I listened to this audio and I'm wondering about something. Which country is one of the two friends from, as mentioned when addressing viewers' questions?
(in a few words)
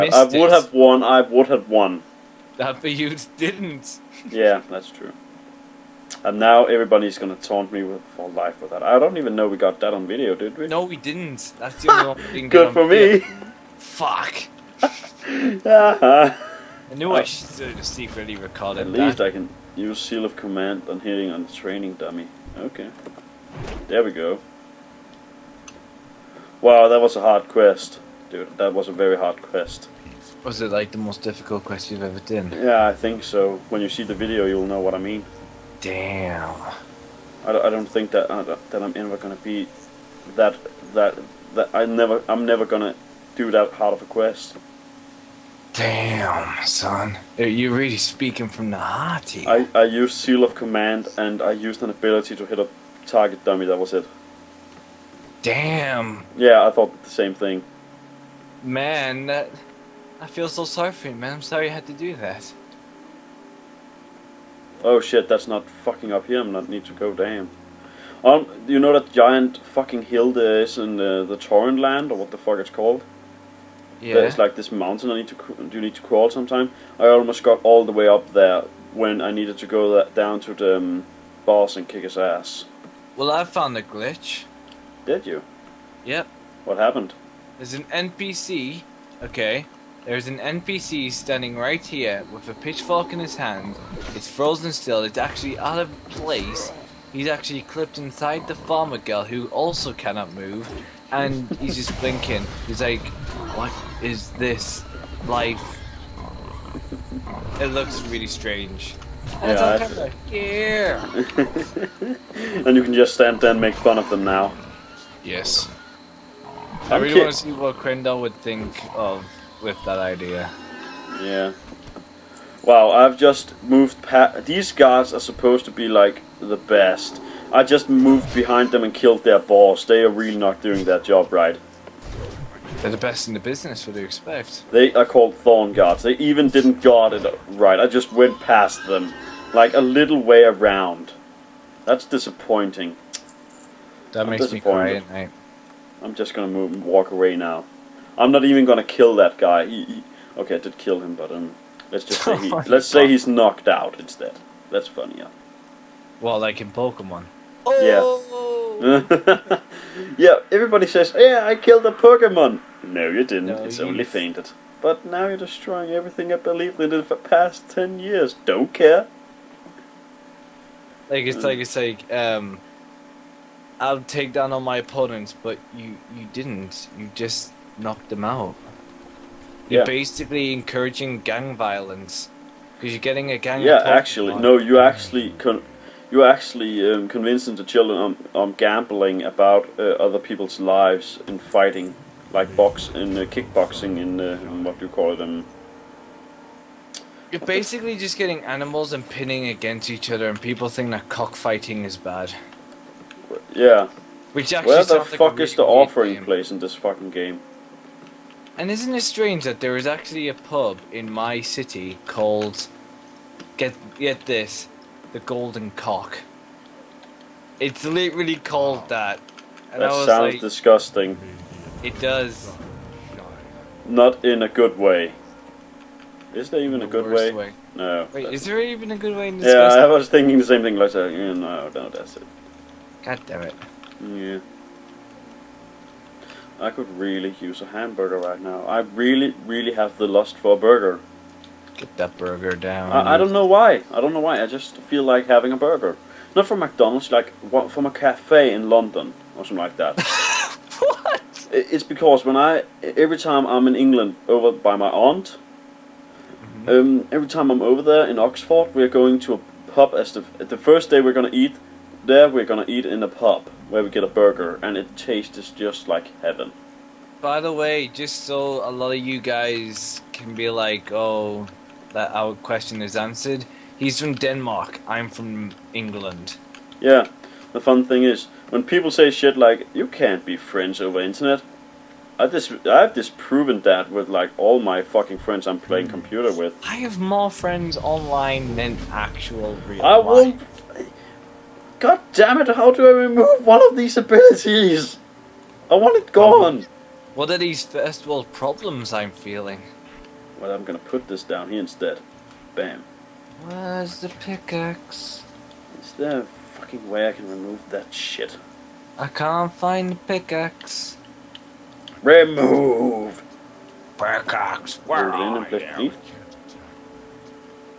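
Denmark.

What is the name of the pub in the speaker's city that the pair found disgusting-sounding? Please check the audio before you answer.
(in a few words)
The Golden Cock.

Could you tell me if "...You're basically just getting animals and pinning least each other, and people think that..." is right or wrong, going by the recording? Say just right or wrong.
wrong.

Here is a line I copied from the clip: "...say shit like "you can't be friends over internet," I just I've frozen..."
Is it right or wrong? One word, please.
wrong.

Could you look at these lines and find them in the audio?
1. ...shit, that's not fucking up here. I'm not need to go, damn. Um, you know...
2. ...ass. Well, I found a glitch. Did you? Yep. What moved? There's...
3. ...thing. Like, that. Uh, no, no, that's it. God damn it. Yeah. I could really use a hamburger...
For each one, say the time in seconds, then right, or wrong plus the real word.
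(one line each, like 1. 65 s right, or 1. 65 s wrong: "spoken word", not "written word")
1. 65 s right
2. 82 s wrong: "happened", not "moved"
3. 230 s right.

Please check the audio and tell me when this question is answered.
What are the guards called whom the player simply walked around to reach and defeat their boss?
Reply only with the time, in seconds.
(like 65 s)
135 s.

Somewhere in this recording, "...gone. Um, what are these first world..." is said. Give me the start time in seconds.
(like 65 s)
296 s.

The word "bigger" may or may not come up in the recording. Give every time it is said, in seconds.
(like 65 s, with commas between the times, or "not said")
not said.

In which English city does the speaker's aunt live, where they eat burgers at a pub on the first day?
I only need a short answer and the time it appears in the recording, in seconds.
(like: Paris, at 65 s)
Oxford, at 258 s.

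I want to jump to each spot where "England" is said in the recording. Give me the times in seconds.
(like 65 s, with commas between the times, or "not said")
253 s, 275 s.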